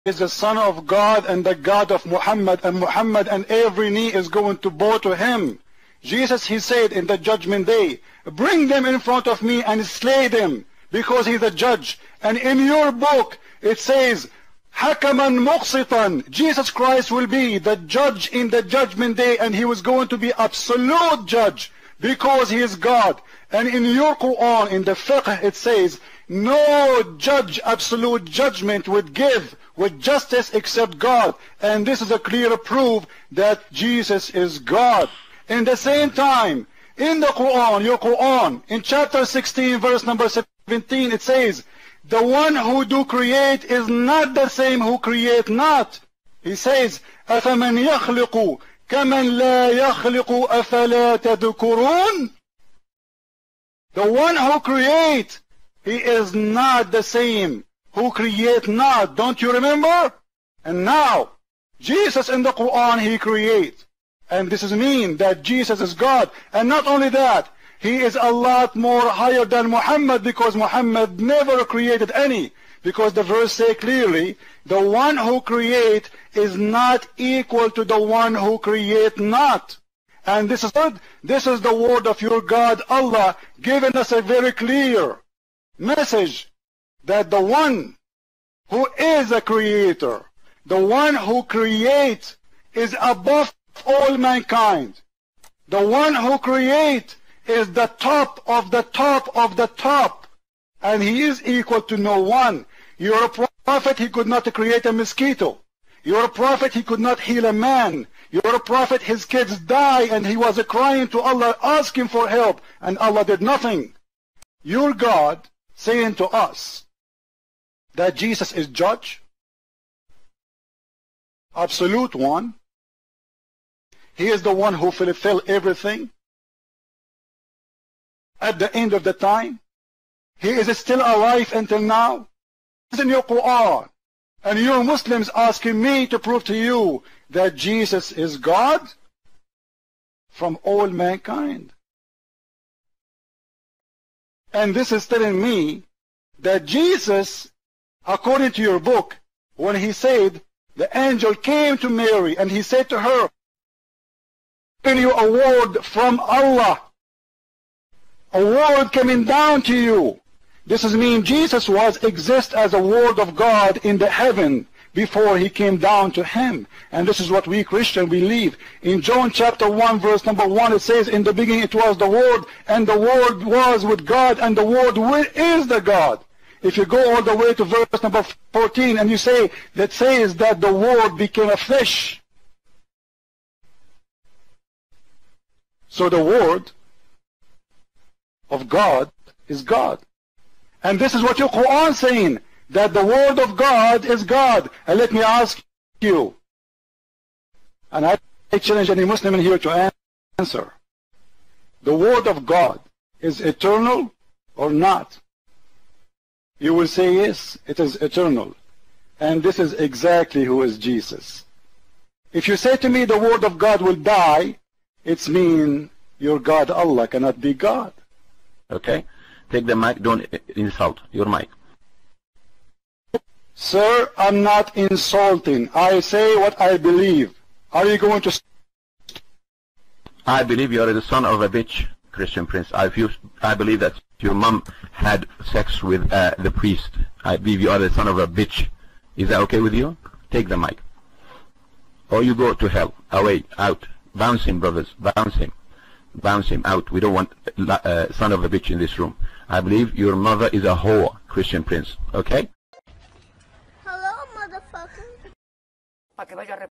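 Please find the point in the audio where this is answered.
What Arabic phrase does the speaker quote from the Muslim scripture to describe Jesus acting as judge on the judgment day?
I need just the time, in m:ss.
0:14.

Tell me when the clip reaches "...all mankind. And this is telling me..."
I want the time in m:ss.
2:20.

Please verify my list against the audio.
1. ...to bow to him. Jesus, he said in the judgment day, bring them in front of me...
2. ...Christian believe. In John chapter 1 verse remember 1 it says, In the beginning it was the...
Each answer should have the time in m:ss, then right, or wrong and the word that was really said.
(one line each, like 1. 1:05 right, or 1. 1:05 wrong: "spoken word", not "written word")
1. 0:04 right
2. 2:47 wrong: "number", not "remember".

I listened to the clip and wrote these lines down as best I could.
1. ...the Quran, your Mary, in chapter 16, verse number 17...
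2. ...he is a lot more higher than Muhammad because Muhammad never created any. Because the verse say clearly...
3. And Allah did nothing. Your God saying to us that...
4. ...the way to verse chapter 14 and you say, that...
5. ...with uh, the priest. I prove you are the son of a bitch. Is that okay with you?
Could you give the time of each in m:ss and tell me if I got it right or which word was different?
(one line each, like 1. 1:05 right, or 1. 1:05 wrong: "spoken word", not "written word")
1. 0:37 wrong: "Quran", not "Mary"
2. 1:07 right
3. 1:52 right
4. 2:57 wrong: "number", not "chapter"
5. 3:55 wrong: "believe", not "prove".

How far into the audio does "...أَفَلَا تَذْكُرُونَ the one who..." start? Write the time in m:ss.
0:50.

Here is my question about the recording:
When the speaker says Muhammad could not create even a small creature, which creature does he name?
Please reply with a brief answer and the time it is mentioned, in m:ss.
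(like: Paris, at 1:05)
mosquito, at 1:44.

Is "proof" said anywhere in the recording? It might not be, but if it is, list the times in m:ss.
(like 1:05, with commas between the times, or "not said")
0:32.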